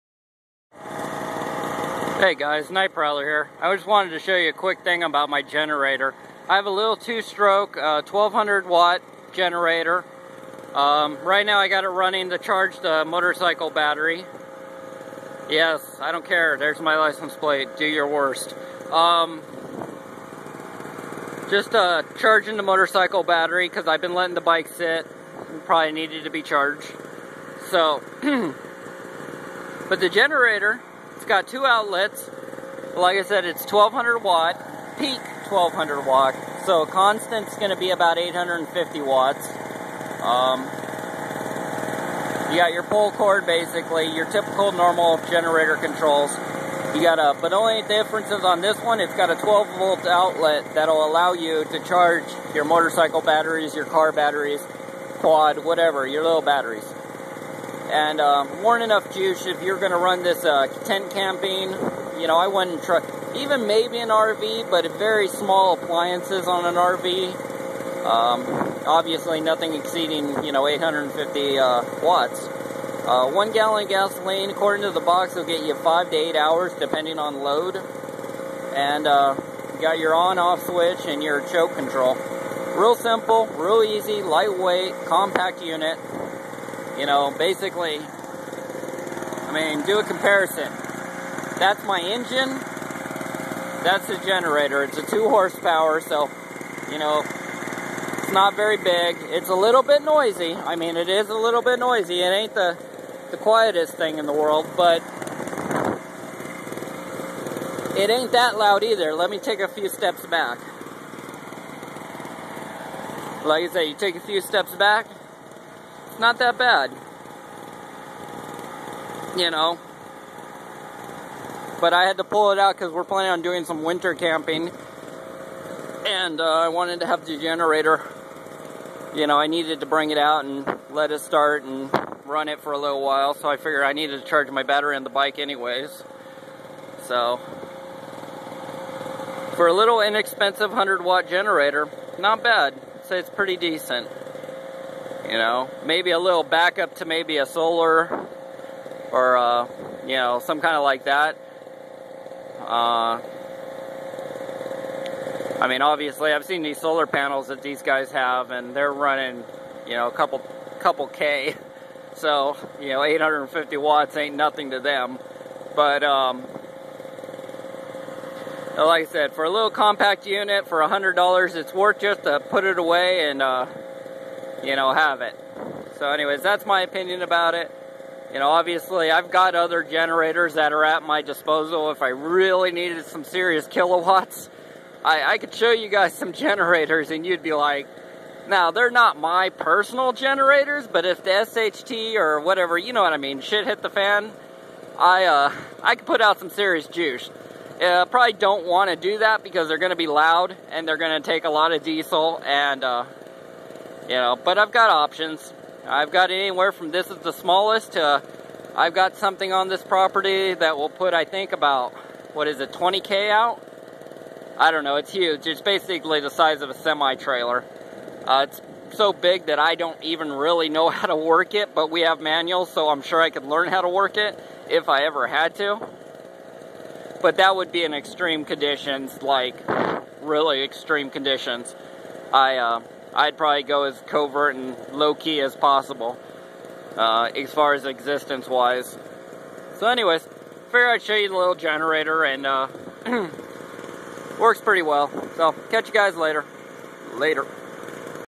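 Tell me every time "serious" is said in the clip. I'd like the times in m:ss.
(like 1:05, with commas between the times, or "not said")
3:03, 3:16.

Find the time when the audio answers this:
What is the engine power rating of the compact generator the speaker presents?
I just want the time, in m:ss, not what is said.
1:35.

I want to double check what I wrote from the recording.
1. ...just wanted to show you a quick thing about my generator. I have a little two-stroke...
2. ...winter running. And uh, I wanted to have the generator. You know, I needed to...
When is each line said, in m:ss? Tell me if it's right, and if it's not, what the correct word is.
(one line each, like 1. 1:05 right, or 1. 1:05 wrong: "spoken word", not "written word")
1. 0:03 right
2. 2:03 wrong: "camping", not "running".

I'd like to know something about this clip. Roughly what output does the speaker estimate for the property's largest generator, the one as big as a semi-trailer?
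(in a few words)
20K.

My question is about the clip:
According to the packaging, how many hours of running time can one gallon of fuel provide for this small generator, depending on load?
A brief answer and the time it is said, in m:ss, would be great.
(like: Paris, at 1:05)
5 to 8 hours, at 1:15.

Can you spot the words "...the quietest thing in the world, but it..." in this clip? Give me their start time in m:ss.
1:43.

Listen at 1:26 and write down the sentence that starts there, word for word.
You know, basically, I mean, do a comparison.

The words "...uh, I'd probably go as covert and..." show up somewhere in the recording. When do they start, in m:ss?
3:52.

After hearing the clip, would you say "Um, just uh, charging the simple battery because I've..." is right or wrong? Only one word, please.
wrong.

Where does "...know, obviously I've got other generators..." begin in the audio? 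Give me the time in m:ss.
2:58.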